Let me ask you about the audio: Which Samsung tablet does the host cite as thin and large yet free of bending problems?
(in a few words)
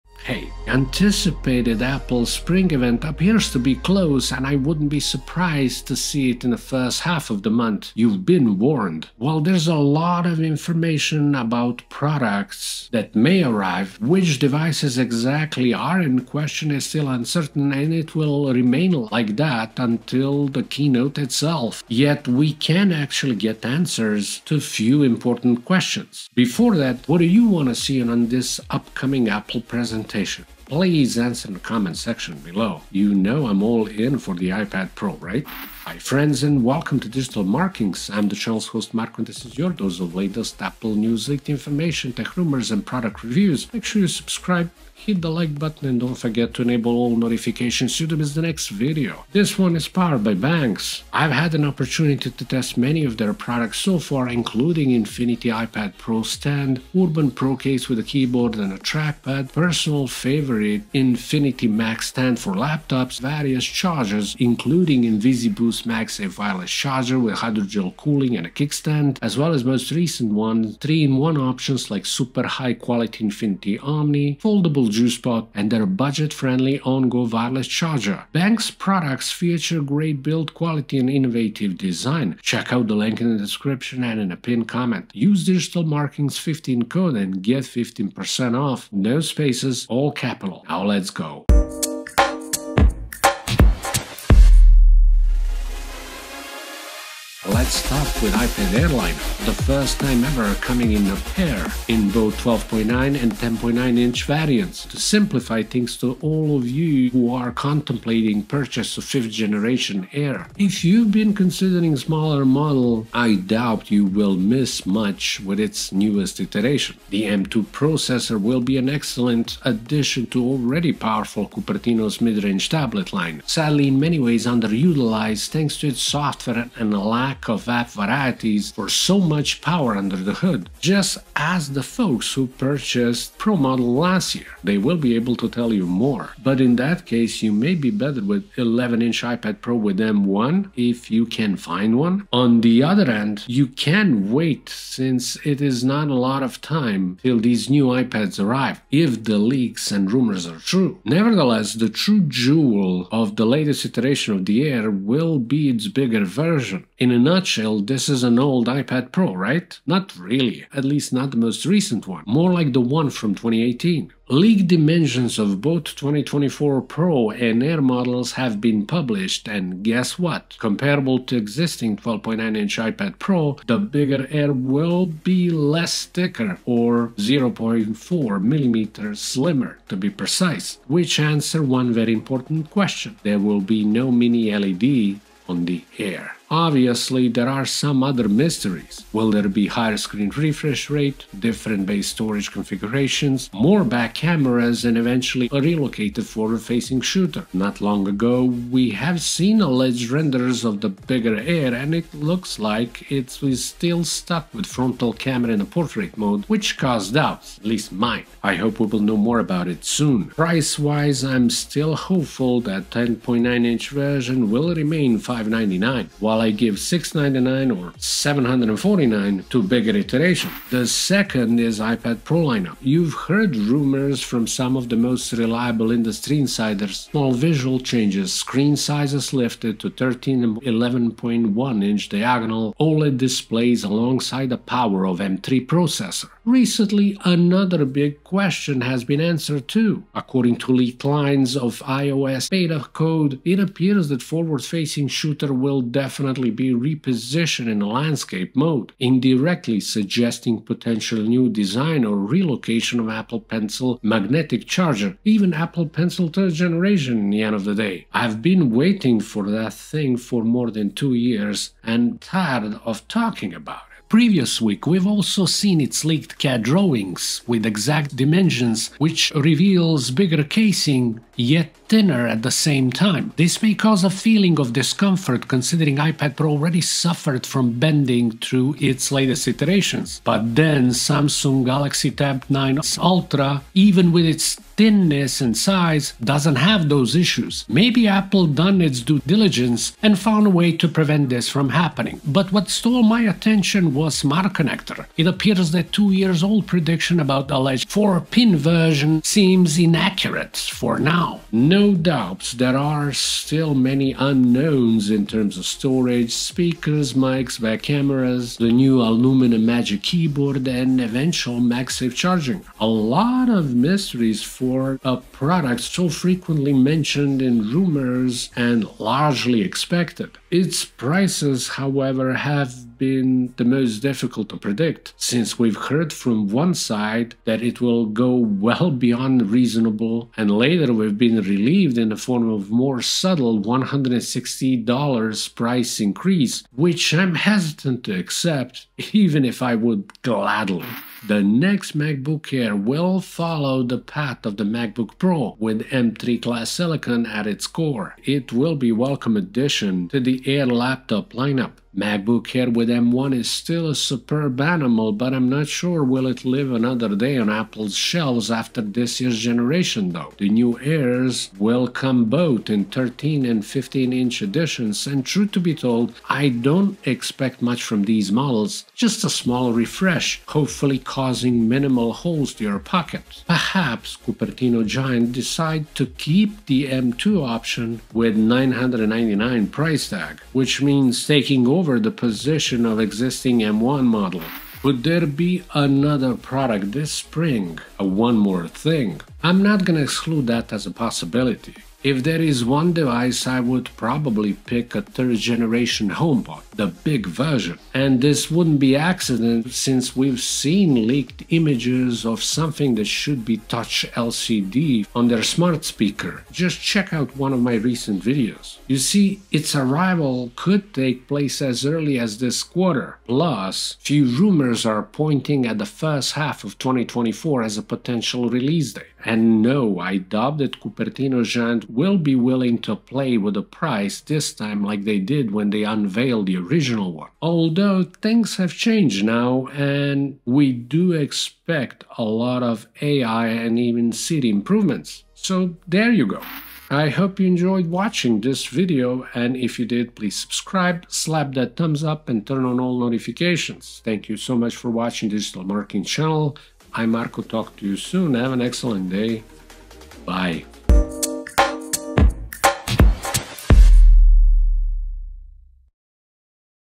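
Samsung Galaxy Tab 9 Ultra.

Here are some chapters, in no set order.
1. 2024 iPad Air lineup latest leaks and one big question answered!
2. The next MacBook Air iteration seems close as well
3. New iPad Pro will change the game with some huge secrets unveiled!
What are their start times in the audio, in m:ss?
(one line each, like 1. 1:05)
1. 1:35
2. 5:41
3. 3:41.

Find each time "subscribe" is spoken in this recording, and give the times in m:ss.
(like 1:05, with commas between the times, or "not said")
0:44, 7:20.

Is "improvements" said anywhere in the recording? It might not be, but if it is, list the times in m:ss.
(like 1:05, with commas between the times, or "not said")
7:14.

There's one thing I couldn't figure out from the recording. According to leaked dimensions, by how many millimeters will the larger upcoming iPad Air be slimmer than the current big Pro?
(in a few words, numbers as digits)
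0.4 millimeters.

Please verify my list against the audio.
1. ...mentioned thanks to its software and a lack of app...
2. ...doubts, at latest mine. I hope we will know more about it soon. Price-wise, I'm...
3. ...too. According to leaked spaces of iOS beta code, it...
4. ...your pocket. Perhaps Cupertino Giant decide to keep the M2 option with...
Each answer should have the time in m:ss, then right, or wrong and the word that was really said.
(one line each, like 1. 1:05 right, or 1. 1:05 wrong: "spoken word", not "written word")
1. 2:04 wrong: "underutilized", not "mentioned"
2. 3:27 wrong: "least", not "latest"
3. 3:59 wrong: "lines", not "spaces"
4. 6:12 right.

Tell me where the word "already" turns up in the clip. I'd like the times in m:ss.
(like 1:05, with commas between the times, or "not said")
2:00, 4:36.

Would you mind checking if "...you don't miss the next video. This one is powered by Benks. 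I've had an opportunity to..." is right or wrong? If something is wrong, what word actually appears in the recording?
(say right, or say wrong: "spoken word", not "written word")
right.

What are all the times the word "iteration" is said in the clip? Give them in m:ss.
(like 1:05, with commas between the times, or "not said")
1:56, 2:33, 3:39, 4:39.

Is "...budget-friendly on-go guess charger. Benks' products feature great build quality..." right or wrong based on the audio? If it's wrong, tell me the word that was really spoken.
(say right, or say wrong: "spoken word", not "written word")
wrong: "wireless", not "guess".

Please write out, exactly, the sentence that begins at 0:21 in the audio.
Yet we can actually get answers to few important questions.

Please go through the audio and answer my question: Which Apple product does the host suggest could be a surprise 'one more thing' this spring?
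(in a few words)
third generation HomePod.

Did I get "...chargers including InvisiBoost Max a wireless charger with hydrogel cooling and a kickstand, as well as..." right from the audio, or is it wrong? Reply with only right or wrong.
right.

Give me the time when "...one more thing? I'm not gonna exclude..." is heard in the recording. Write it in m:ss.
6:28.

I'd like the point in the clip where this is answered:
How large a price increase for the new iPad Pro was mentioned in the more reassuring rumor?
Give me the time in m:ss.
5:33.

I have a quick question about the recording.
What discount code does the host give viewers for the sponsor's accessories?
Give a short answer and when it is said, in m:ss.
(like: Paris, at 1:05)
DIGITALMARKINGS15, at 1:25.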